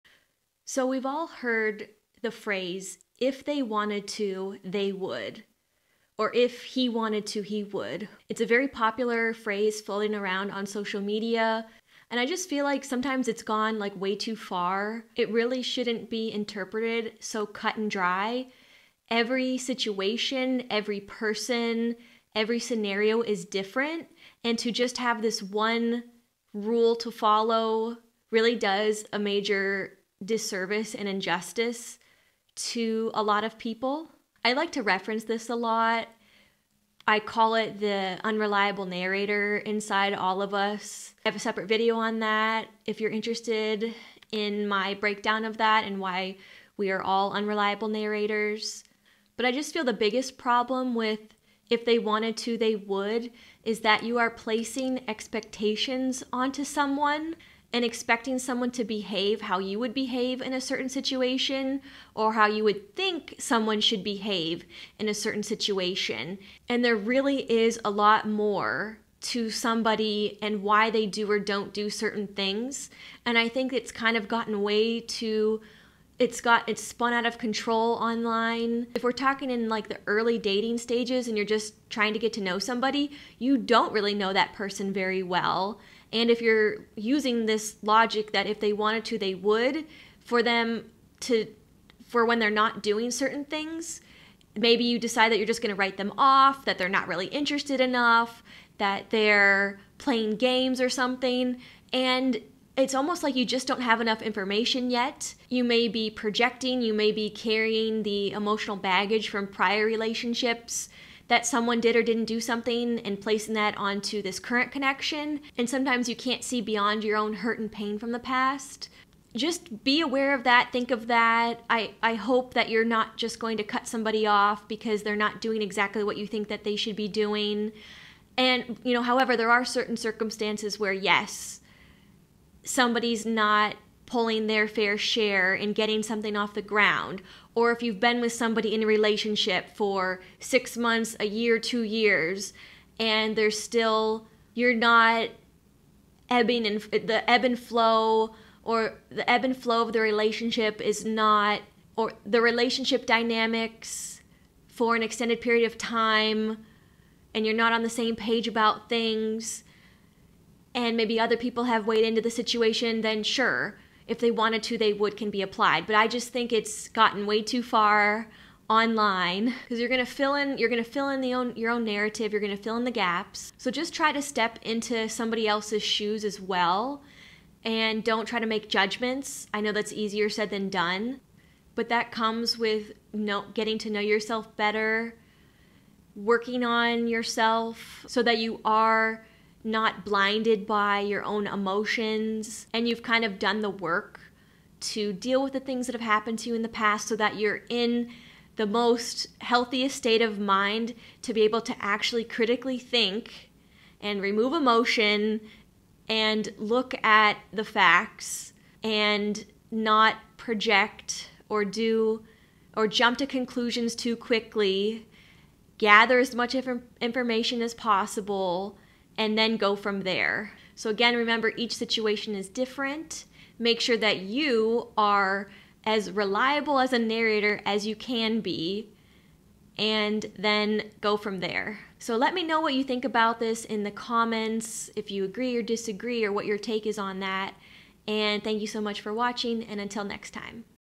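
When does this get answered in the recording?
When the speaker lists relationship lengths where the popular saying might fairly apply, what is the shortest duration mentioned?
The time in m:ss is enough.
2:20.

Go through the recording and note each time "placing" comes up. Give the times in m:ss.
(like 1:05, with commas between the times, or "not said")
0:54, 1:53.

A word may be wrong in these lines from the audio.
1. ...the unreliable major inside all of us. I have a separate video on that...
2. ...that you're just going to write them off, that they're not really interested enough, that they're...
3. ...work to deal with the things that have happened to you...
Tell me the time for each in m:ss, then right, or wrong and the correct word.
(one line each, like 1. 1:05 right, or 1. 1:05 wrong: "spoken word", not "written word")
1. 0:37 wrong: "narrator", not "major"
2. 1:35 right
3. 3:13 right.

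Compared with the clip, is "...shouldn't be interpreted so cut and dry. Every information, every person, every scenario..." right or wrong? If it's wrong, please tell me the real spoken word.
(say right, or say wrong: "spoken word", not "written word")
wrong: "situation", not "information".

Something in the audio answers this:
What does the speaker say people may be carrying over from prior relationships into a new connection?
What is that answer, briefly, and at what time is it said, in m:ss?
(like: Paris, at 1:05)
emotional baggage, at 1:48.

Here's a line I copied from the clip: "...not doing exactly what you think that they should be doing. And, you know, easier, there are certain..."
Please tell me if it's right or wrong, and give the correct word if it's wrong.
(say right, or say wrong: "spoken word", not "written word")
wrong: "however", not "easier".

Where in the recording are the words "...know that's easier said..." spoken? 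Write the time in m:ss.
2:59.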